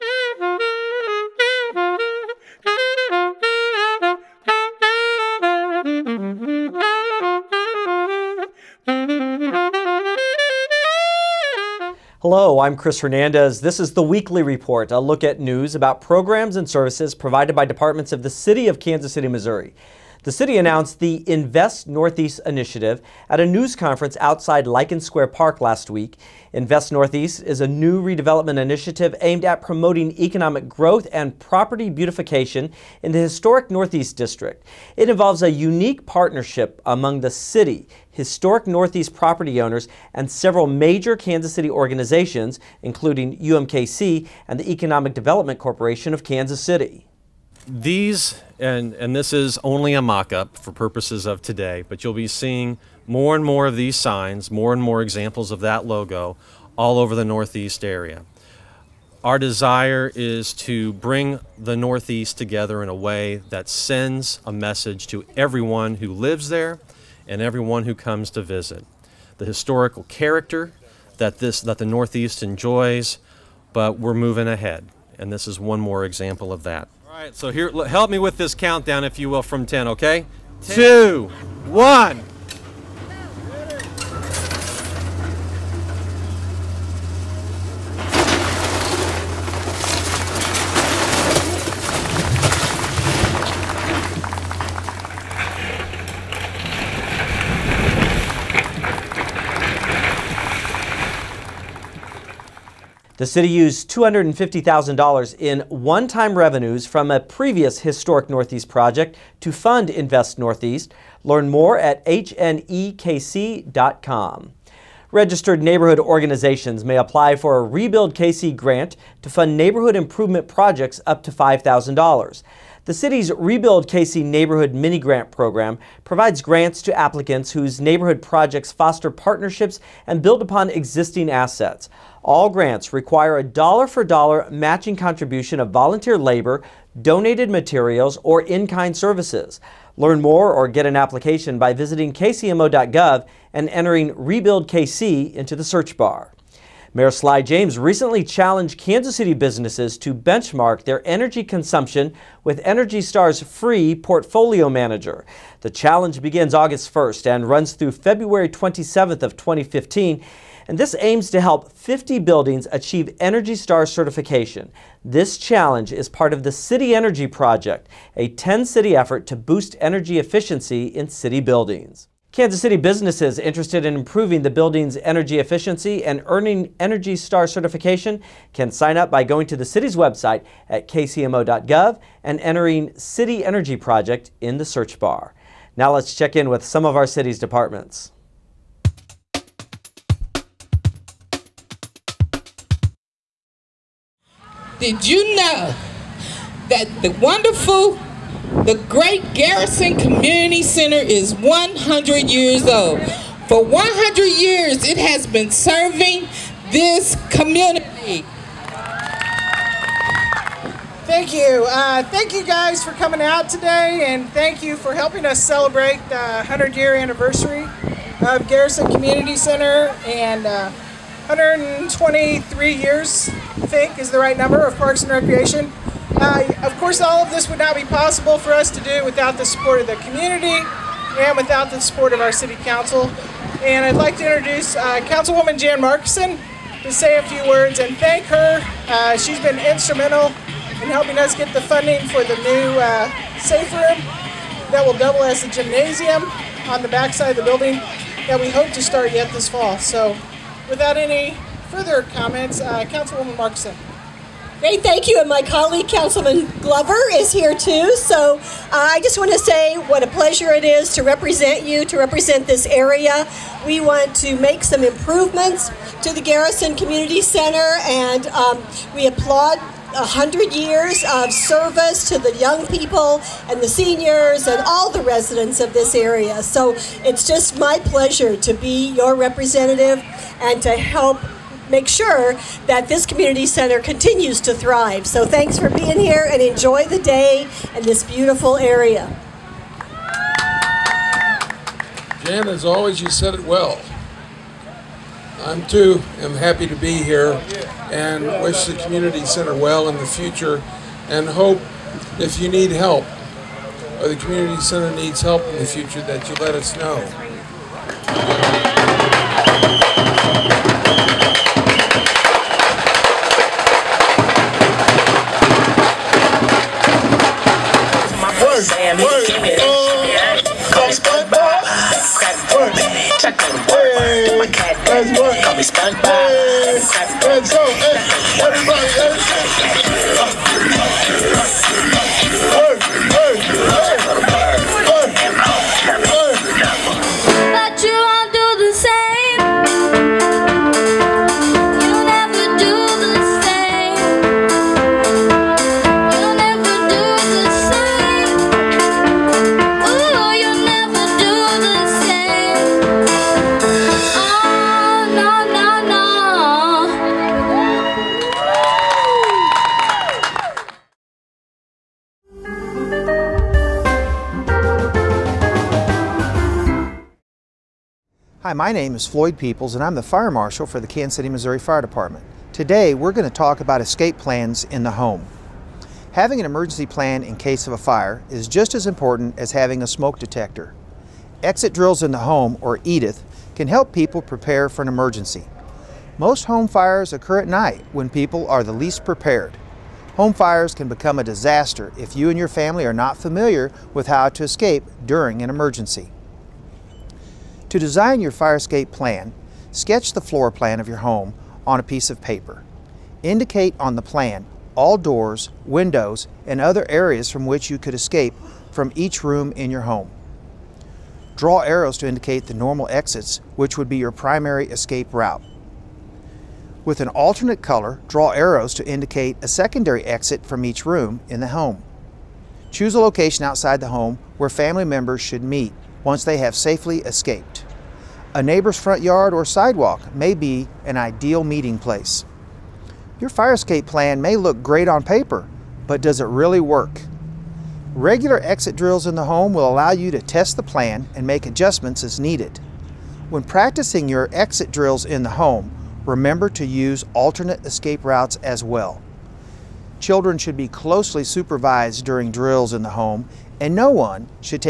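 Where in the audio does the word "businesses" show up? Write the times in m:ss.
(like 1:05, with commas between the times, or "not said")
2:29, 2:52.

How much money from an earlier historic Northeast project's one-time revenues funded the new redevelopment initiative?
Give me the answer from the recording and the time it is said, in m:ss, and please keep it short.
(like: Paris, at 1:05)
$250,000, at 1:43.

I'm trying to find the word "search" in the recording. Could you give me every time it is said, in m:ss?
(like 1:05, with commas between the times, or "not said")
2:25, 3:04.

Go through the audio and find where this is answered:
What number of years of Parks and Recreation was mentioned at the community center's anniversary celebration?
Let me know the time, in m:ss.
3:41.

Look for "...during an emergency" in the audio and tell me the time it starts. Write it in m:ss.
6:35.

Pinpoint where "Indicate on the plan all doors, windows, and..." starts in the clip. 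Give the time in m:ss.
6:43.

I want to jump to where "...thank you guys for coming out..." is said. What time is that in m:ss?
3:32.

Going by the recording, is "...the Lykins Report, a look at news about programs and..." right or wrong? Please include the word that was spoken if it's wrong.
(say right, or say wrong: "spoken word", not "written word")
wrong: "Weekly", not "Lykins".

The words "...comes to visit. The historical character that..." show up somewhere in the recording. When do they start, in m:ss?
1:07.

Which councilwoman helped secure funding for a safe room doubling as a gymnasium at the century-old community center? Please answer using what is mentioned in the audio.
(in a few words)
Jan Marcason.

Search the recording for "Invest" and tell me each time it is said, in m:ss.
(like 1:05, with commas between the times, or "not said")
0:21, 0:26, 1:49.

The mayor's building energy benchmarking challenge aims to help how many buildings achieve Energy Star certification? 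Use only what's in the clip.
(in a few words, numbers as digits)
50.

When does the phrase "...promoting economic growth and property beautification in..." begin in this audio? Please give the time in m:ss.
0:29.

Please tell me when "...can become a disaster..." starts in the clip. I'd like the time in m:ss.
6:30.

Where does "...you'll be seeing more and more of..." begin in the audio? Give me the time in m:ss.
0:52.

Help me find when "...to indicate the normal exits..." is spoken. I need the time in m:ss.
6:51.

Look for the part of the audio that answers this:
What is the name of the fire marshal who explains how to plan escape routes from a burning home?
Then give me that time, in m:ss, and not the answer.
6:09.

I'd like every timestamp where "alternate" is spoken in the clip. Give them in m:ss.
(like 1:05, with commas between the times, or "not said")
6:57, 7:27.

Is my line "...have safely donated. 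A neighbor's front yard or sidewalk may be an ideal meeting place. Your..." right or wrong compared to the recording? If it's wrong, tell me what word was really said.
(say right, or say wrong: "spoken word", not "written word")
wrong: "escaped", not "donated".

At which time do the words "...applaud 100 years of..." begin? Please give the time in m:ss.
4:29.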